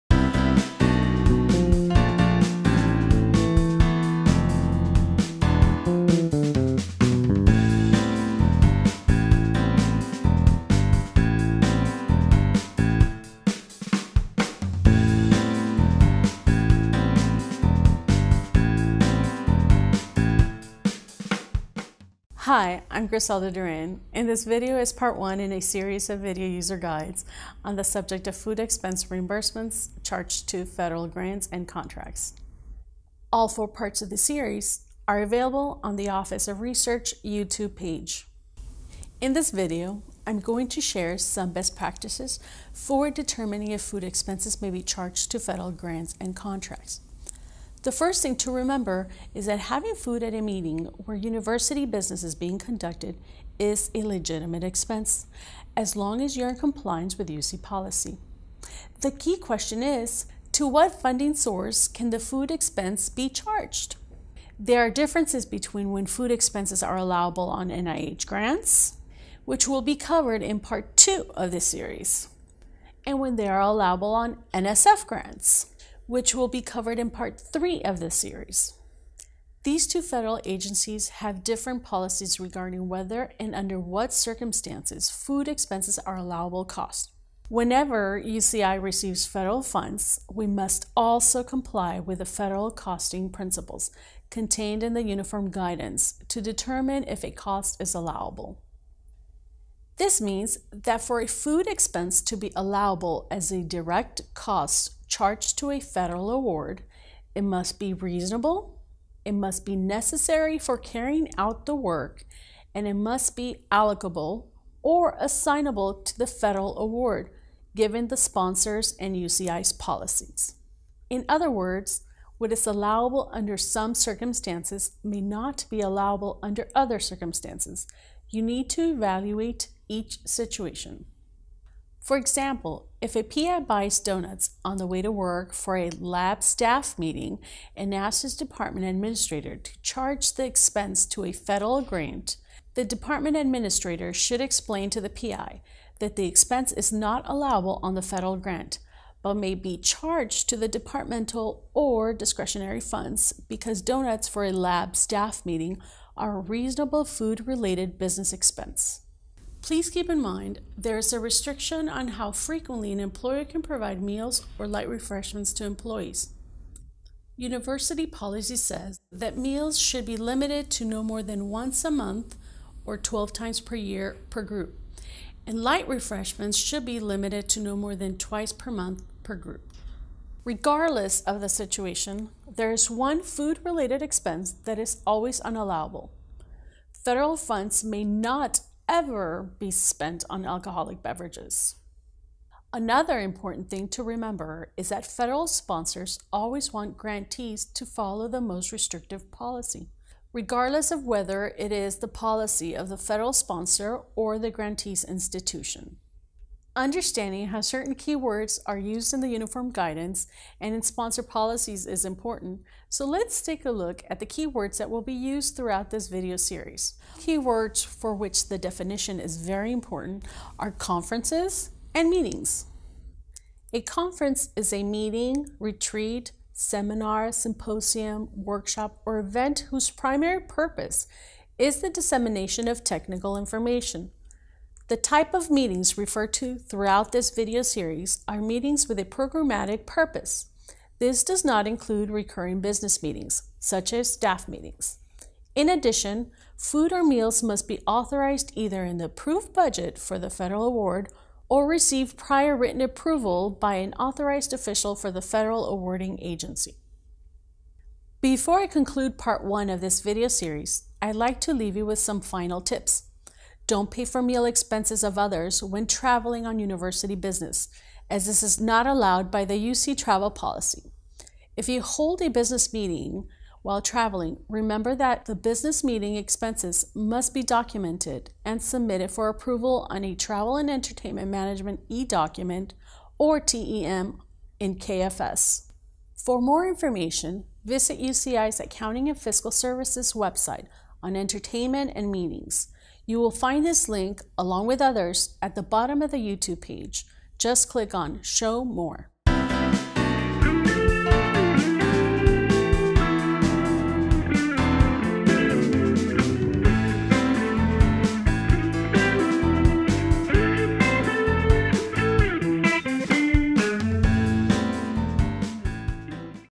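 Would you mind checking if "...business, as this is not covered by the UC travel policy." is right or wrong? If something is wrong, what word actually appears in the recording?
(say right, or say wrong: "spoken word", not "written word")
wrong: "allowed", not "covered".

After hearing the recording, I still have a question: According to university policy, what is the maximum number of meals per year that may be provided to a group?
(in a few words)
12.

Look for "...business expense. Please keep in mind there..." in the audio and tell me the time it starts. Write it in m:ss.
2:37.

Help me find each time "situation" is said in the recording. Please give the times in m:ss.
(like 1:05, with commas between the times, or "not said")
2:10, 3:01.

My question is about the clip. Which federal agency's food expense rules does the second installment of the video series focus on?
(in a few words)
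NIH.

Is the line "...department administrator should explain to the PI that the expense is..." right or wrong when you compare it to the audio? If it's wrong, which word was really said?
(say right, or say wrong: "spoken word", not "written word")
right.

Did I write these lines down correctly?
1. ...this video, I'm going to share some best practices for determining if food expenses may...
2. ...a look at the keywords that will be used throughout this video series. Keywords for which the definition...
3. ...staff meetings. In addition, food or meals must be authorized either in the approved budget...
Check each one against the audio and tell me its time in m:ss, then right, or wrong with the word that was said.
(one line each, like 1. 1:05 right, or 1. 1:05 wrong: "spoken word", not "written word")
1. 0:39 right
2. 3:33 right
3. 4:04 right.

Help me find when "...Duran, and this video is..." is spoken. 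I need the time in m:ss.
0:23.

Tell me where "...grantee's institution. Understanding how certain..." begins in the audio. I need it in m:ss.
3:24.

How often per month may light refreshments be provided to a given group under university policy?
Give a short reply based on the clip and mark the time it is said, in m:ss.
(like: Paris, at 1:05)
twice, at 2:58.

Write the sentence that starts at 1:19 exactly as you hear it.
These two federal agencies have different policies regarding whether and under what circumstances food expenses are allowable costs.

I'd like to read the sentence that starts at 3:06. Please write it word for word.
Federal funds may not ever be spent on alcoholic beverages.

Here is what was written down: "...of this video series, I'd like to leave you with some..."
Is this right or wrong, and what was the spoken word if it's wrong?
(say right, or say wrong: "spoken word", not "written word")
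right.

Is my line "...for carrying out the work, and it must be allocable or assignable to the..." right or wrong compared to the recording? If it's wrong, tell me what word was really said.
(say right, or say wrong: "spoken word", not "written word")
right.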